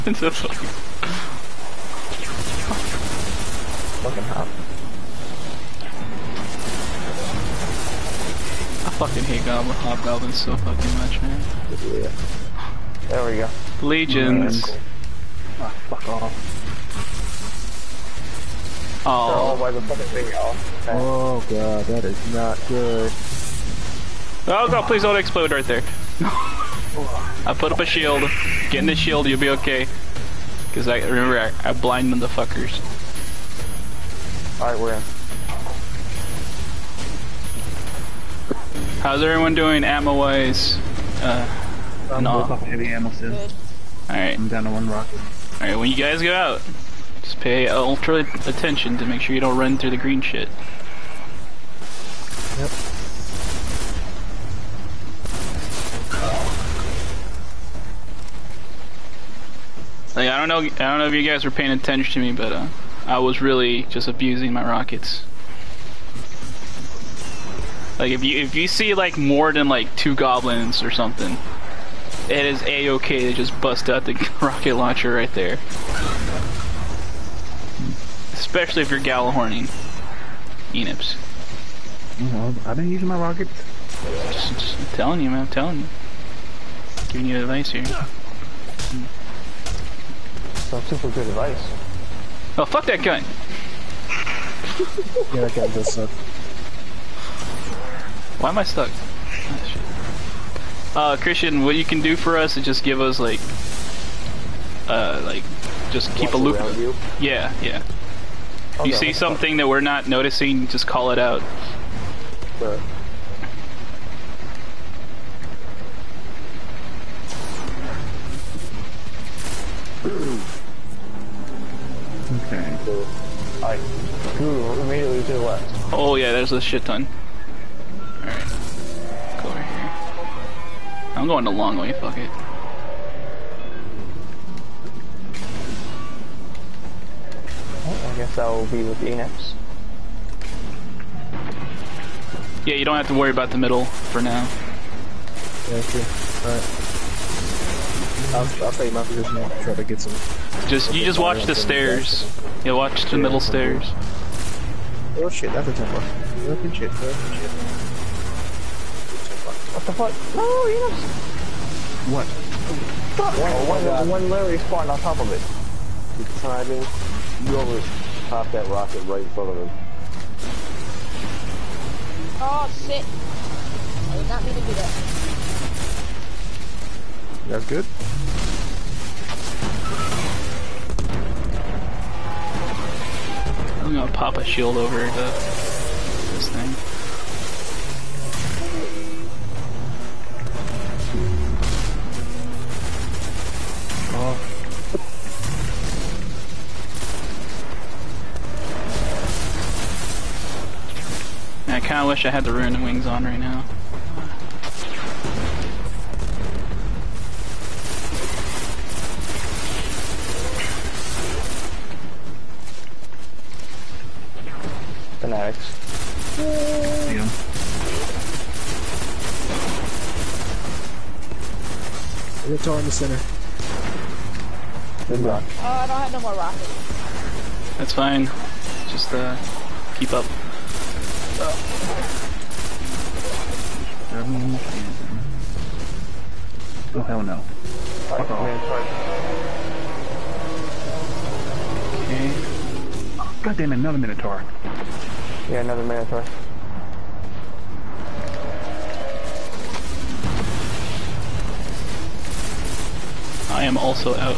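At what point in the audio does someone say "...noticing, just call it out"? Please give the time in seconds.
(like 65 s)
110 s.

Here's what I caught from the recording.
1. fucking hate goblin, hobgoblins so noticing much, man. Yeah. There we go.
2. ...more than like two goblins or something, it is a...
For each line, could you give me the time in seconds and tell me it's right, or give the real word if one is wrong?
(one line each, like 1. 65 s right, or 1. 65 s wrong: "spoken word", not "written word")
1. 8 s wrong: "fucking", not "noticing"
2. 69 s right.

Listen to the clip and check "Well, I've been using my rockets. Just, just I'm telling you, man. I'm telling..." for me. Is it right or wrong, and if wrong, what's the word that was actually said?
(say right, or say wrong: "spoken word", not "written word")
right.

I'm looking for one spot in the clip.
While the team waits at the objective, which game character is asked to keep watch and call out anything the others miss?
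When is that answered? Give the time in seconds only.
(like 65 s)
101 s.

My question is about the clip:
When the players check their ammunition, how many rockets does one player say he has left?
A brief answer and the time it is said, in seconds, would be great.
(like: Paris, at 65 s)
1, at 44 s.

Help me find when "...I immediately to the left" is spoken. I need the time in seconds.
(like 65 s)
123 s.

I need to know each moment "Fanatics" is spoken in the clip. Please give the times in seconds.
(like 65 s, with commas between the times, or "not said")
215 s.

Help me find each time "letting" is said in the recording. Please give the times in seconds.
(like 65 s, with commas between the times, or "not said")
not said.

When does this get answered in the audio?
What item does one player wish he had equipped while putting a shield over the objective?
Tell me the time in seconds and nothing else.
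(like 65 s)
202 s.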